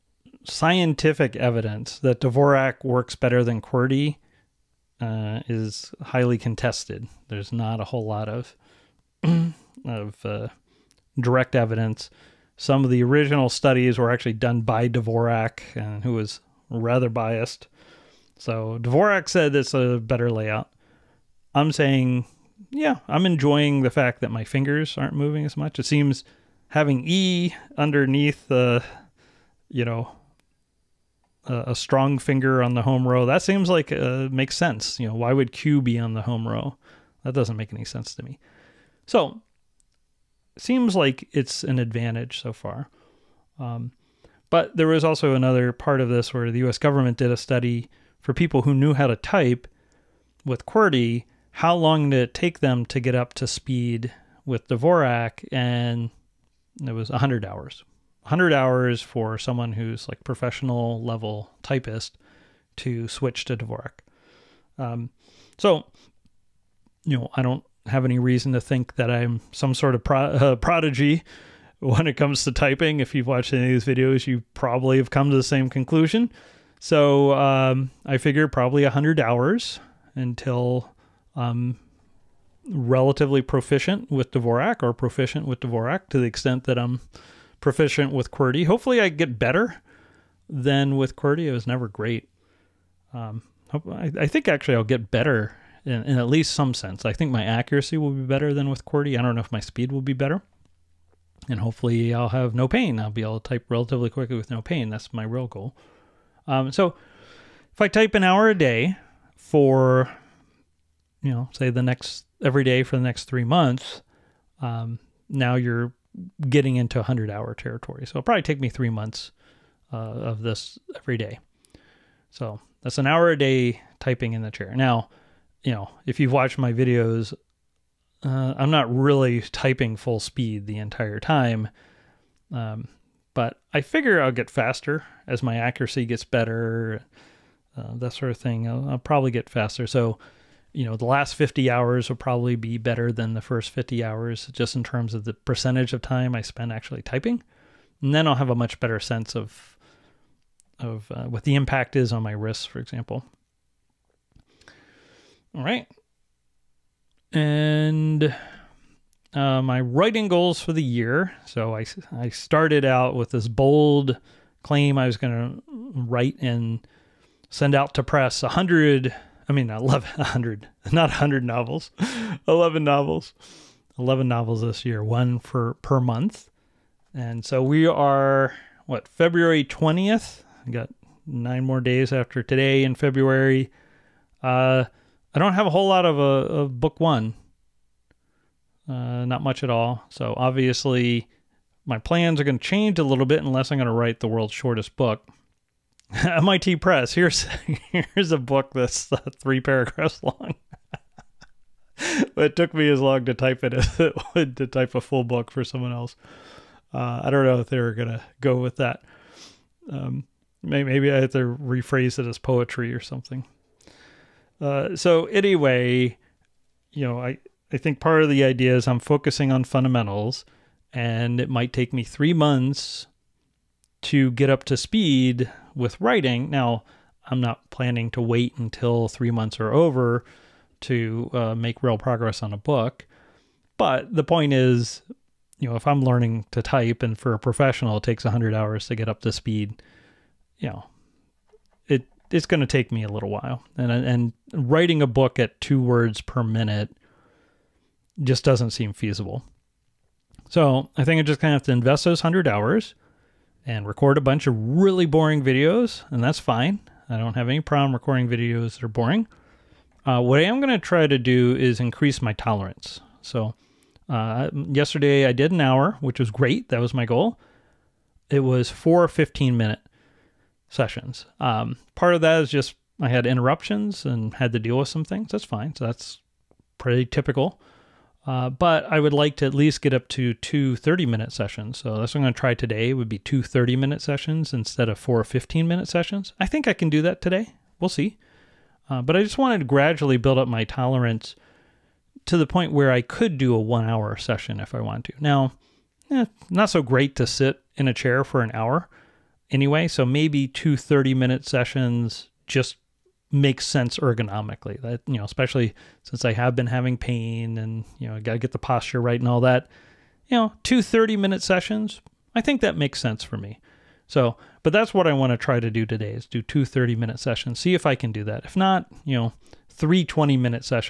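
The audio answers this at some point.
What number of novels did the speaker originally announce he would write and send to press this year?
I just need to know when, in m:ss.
2:53.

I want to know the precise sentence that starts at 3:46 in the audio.
Now, I'm not planning to wait until three months are over to uh, make real progress on a book.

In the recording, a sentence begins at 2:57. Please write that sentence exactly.
And so we are, what, February 20th?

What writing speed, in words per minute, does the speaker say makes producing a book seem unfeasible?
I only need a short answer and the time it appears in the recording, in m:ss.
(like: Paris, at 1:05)
2 words per minute, at 4:05.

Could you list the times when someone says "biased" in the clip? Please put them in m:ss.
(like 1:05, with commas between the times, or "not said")
0:17.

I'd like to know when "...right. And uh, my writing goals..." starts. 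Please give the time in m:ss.
2:35.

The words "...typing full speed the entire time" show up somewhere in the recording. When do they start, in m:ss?
2:09.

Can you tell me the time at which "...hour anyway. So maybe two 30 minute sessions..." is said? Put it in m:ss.
4:58.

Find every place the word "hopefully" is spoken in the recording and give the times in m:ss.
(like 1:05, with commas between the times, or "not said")
1:28, 1:41.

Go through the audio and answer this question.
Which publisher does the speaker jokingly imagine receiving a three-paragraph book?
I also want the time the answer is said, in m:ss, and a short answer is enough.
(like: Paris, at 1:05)
MIT Press, at 3:16.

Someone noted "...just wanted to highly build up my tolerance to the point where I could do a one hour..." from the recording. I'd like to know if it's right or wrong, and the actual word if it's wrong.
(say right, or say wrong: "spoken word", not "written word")
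wrong: "gradually", not "highly".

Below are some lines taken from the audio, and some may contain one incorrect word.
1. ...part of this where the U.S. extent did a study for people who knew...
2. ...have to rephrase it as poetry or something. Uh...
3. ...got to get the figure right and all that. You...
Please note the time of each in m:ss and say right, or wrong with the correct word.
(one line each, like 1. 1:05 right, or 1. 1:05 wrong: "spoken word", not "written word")
1. 0:45 wrong: "government", not "extent"
2. 3:31 right
3. 5:08 wrong: "posture", not "figure".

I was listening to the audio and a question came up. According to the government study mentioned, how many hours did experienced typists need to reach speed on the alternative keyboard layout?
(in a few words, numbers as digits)
100 hours.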